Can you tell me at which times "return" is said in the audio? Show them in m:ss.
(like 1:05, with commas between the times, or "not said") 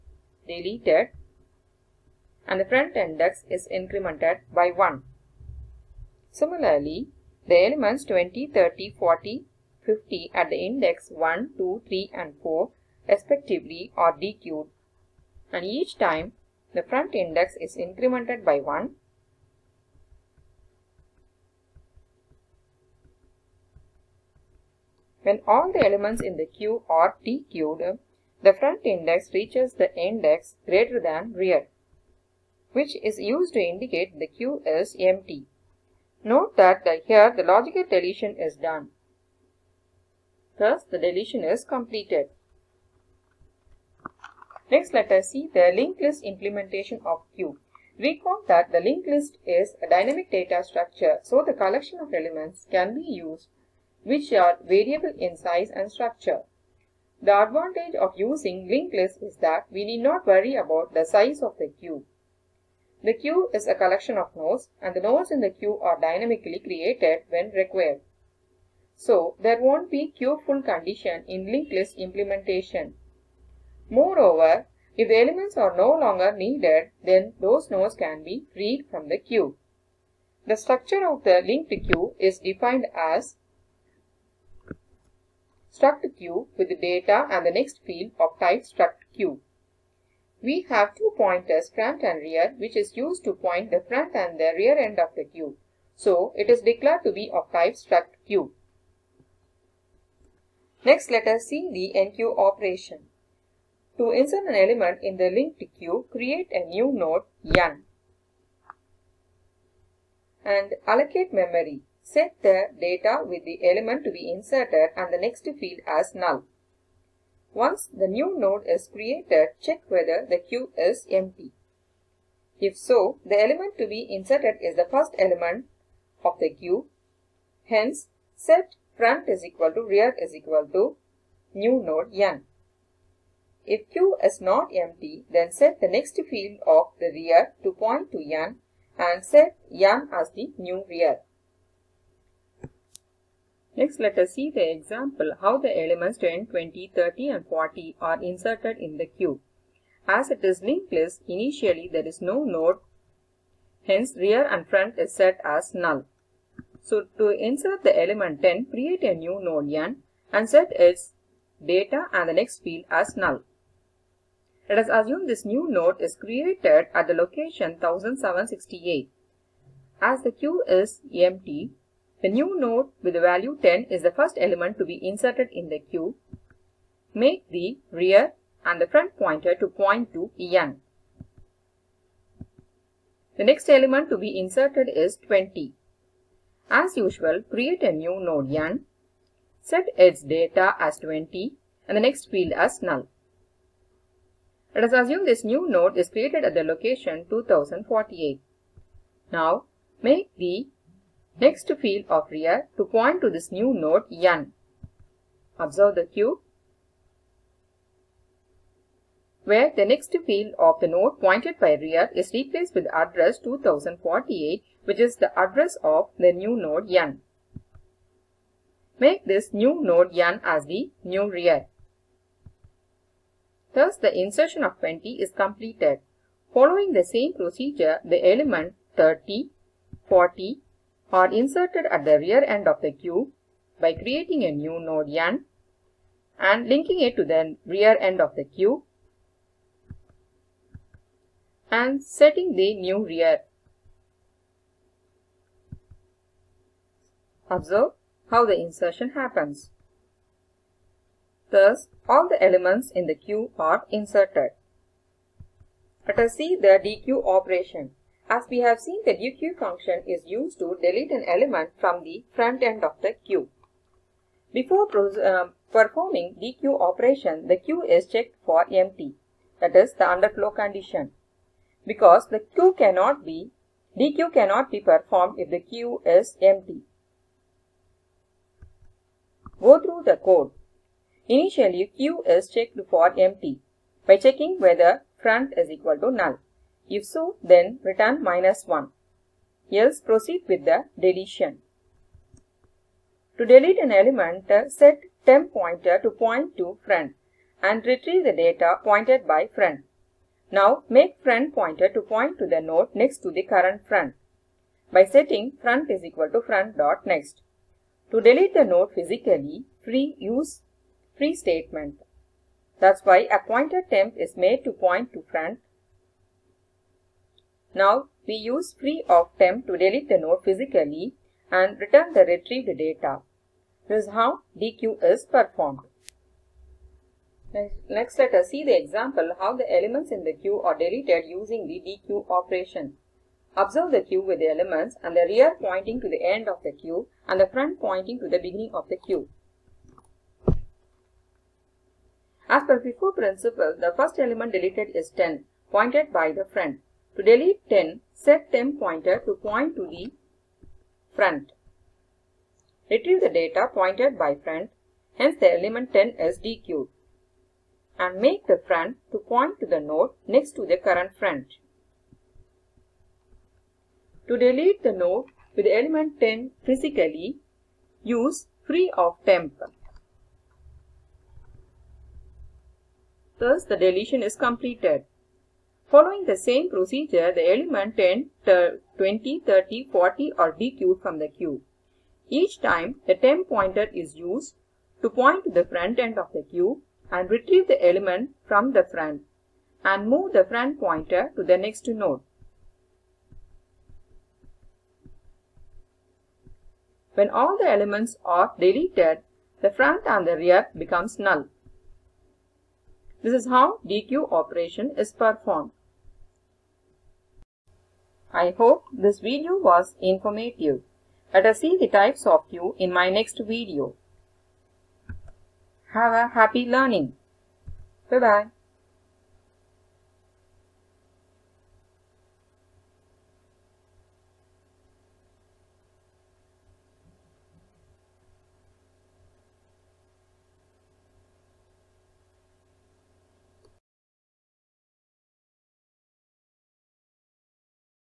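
4:47, 5:21.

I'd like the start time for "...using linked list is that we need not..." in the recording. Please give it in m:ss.
0:58.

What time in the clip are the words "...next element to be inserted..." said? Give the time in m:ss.
3:03.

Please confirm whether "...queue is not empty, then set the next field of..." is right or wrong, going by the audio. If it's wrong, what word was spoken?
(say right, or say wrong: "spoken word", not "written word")
right.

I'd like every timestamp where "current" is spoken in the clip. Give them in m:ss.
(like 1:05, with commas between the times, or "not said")
5:03, 6:00.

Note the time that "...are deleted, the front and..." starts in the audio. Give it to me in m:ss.
6:38.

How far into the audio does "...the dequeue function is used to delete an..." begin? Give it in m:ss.
4:19.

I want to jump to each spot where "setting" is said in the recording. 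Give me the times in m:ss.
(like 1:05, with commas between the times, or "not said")
4:02, 5:05.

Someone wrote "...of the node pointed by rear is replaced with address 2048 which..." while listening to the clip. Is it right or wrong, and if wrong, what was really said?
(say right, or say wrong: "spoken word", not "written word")
right.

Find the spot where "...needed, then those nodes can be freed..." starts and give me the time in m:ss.
1:16.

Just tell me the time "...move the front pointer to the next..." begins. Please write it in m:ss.
6:30.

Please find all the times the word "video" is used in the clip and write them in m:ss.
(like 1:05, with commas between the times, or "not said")
6:49, 6:53.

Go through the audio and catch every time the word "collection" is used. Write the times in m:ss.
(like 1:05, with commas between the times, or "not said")
0:51, 1:03.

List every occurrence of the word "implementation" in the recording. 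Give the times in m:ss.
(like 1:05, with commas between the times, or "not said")
0:46, 1:11.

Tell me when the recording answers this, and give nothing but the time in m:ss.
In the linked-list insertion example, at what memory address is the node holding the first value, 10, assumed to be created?
2:47.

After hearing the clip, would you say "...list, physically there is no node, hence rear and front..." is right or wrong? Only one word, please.
wrong.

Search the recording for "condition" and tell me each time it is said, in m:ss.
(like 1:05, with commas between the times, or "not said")
1:10, 4:30.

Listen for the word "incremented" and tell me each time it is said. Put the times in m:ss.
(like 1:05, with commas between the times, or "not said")
0:03, 0:17.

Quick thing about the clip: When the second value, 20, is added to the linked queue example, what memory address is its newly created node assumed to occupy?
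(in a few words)
2048.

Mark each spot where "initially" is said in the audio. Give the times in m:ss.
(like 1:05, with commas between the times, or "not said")
2:31, 4:41.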